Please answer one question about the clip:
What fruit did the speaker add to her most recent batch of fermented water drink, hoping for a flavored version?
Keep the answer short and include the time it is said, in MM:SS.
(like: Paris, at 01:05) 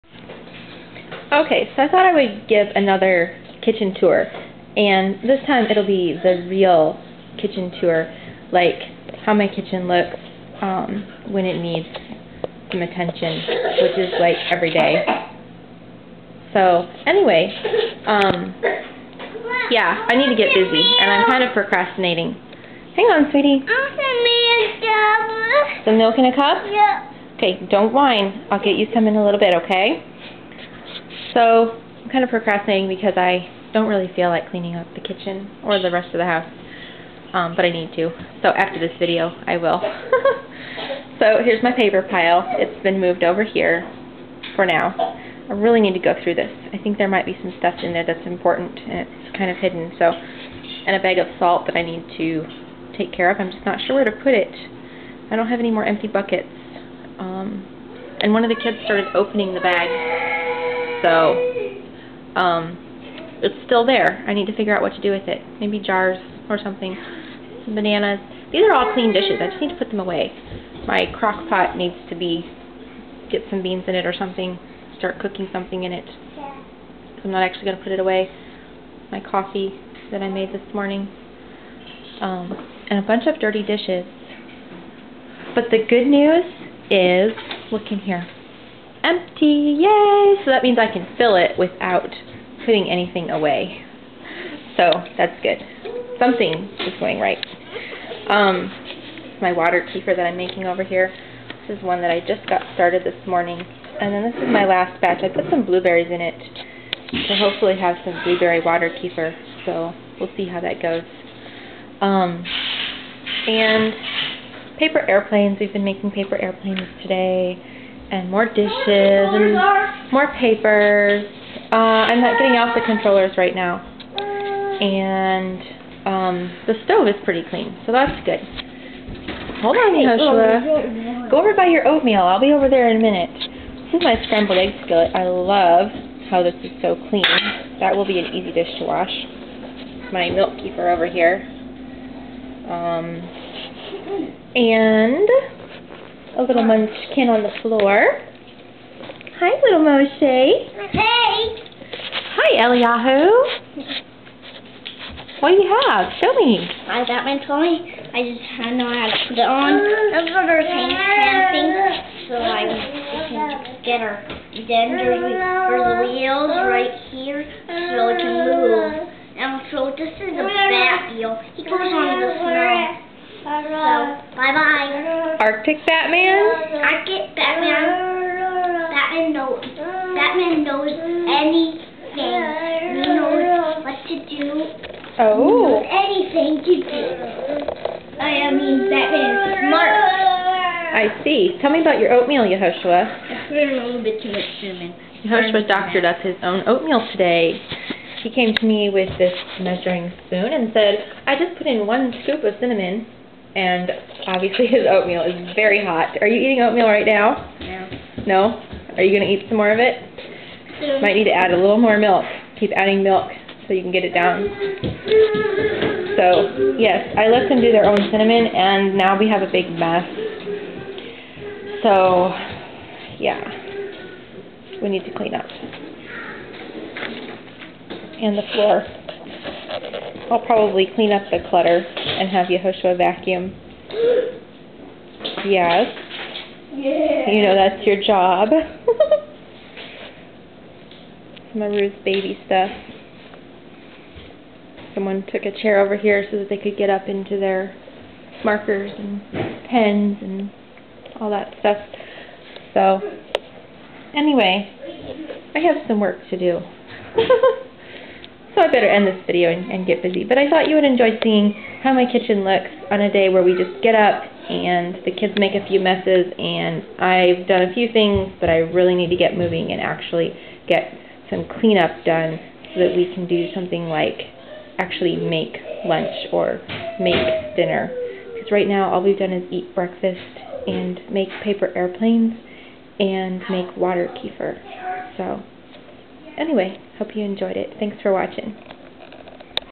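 Blueberries, at 01:45.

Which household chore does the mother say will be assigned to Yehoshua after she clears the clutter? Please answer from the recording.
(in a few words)
Vacuum.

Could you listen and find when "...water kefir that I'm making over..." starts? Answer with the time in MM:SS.
01:39.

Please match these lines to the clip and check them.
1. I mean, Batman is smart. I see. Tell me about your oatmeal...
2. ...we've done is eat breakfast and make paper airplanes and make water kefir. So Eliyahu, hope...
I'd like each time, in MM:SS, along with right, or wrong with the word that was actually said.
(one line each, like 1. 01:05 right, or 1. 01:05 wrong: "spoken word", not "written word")
1. 03:08 right
2. 04:39 wrong: "Anyway", not "Eliyahu".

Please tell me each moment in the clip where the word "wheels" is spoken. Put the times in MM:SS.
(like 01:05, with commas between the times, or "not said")
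02:46, 02:51.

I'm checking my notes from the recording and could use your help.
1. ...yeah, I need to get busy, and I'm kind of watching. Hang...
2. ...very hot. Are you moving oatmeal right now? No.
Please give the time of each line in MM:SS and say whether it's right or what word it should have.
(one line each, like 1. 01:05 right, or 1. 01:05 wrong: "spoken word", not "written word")
1. 00:19 wrong: "procrastinating", not "watching"
2. 03:25 wrong: "eating", not "moving".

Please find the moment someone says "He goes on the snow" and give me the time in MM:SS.
02:51.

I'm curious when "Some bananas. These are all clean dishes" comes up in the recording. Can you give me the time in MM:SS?
01:07.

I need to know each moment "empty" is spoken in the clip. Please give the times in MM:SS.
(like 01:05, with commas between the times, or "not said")
00:55, 01:29.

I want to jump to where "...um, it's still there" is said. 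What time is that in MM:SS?
01:02.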